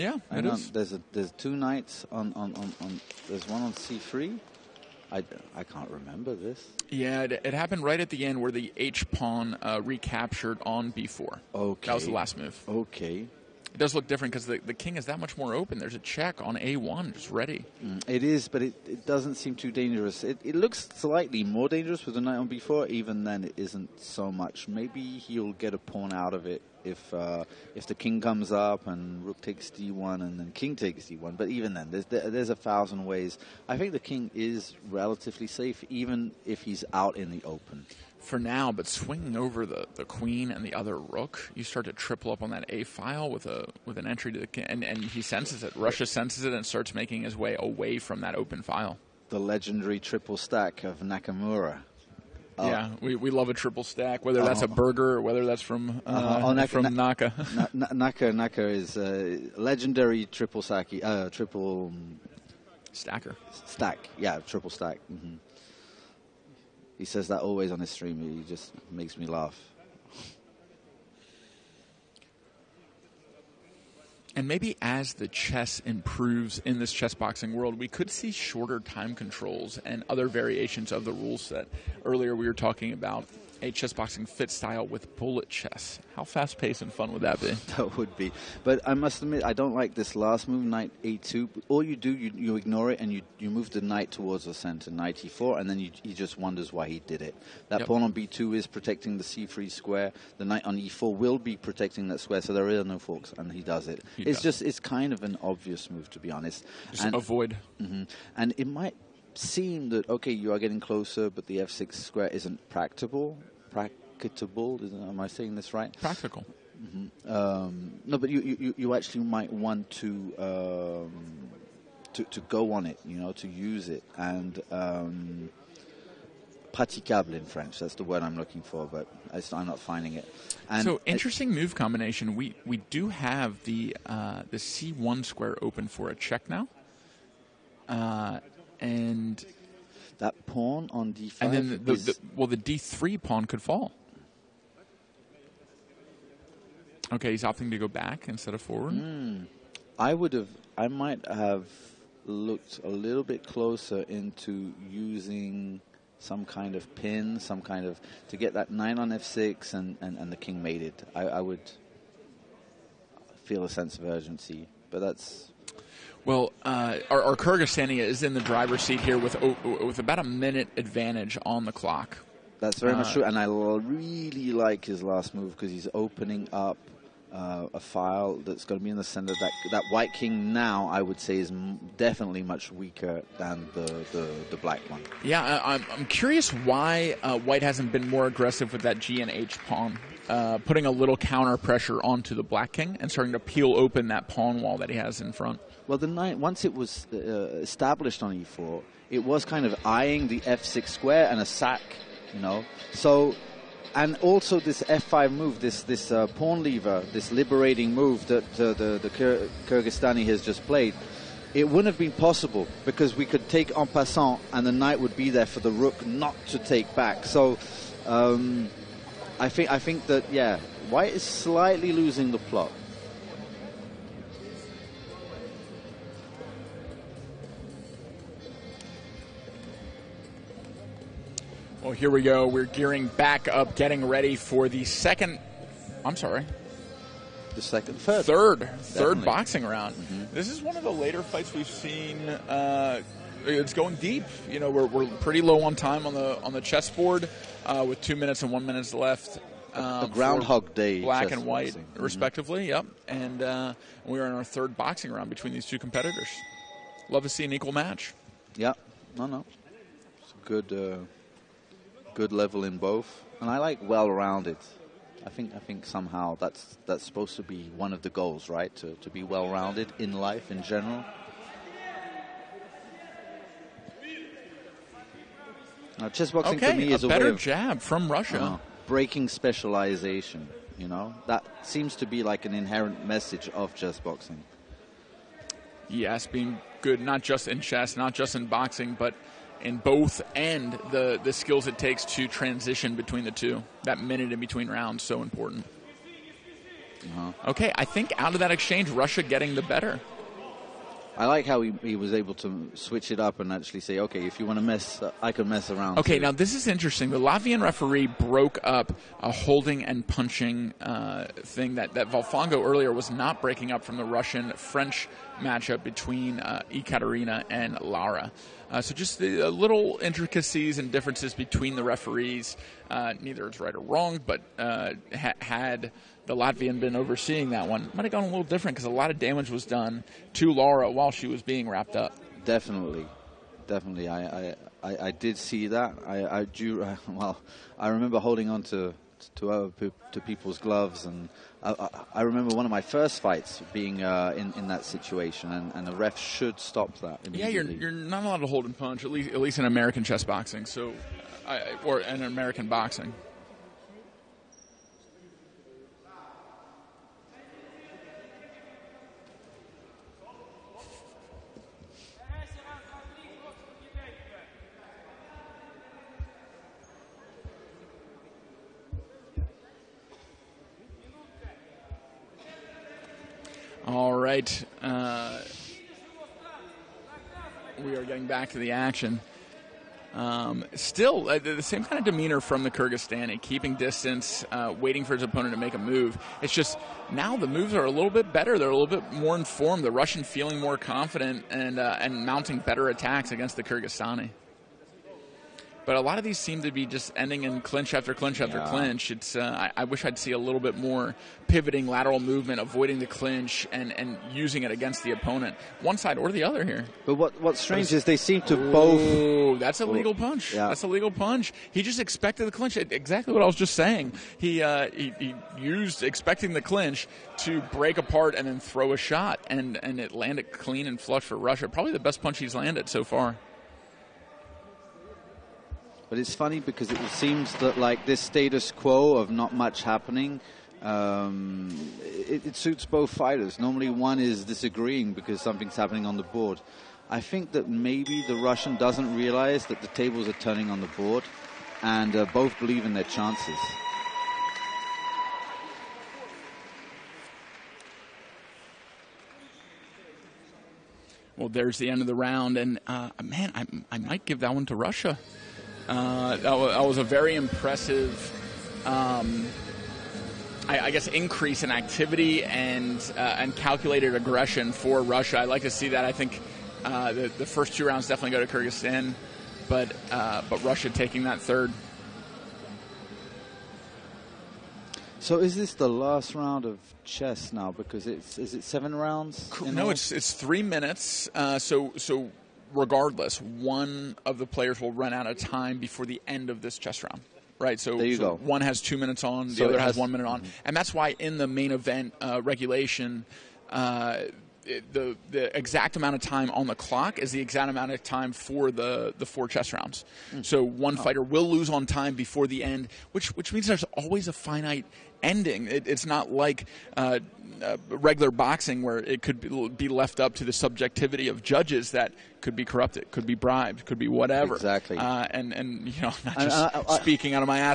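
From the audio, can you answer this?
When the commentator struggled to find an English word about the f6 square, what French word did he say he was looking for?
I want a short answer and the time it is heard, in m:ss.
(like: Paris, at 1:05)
praticable, at 2:06.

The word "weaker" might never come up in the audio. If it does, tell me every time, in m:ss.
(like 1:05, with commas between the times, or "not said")
3:02.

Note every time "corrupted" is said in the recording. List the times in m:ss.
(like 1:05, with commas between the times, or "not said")
8:32.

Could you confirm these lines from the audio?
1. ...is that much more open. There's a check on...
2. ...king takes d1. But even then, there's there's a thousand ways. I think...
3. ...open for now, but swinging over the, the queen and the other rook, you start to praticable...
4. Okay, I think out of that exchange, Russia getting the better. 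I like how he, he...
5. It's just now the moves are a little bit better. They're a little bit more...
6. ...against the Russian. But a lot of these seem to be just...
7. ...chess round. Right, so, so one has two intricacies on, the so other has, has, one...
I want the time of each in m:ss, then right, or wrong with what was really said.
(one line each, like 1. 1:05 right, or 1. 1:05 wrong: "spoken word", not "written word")
1. 0:14 right
2. 0:30 right
3. 0:37 wrong: "triple", not "praticable"
4. 4:57 right
5. 6:26 right
6. 6:33 wrong: "Kyrgyzstani", not "Russian"
7. 8:06 wrong: "minutes", not "intricacies".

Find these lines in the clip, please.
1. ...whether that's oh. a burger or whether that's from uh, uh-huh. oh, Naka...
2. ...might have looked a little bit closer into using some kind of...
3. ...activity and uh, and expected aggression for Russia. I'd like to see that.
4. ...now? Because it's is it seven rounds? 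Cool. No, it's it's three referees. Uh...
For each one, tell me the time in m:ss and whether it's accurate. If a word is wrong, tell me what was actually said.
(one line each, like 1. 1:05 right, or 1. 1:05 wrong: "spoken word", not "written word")
1. 0:54 right
2. 2:30 right
3. 7:41 wrong: "calculated", not "expected"
4. 7:57 wrong: "minutes", not "referees".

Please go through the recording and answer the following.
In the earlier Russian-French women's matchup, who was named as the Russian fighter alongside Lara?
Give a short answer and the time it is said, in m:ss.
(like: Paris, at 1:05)
Ekaterina, at 5:16.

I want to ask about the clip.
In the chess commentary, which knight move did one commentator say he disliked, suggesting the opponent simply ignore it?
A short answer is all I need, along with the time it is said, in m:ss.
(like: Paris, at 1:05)
Knight a2, at 1:30.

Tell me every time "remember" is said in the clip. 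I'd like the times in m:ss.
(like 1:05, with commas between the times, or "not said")
0:05, 5:37, 5:42.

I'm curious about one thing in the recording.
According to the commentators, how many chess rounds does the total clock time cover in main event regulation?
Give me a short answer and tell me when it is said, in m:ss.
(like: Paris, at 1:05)
4, at 8:19.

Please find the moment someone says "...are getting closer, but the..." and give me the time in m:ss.
1:50.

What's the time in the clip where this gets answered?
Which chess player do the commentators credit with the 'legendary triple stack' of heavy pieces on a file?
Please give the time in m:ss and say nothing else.
0:51.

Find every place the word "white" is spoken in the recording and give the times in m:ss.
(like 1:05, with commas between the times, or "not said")
2:59, 3:07, 3:40, 4:11.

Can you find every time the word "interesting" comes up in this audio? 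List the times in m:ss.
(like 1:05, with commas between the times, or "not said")
2:11, 5:06.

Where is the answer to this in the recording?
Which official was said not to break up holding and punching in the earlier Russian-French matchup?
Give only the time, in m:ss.
5:12.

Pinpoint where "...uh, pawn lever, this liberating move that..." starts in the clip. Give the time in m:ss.
3:26.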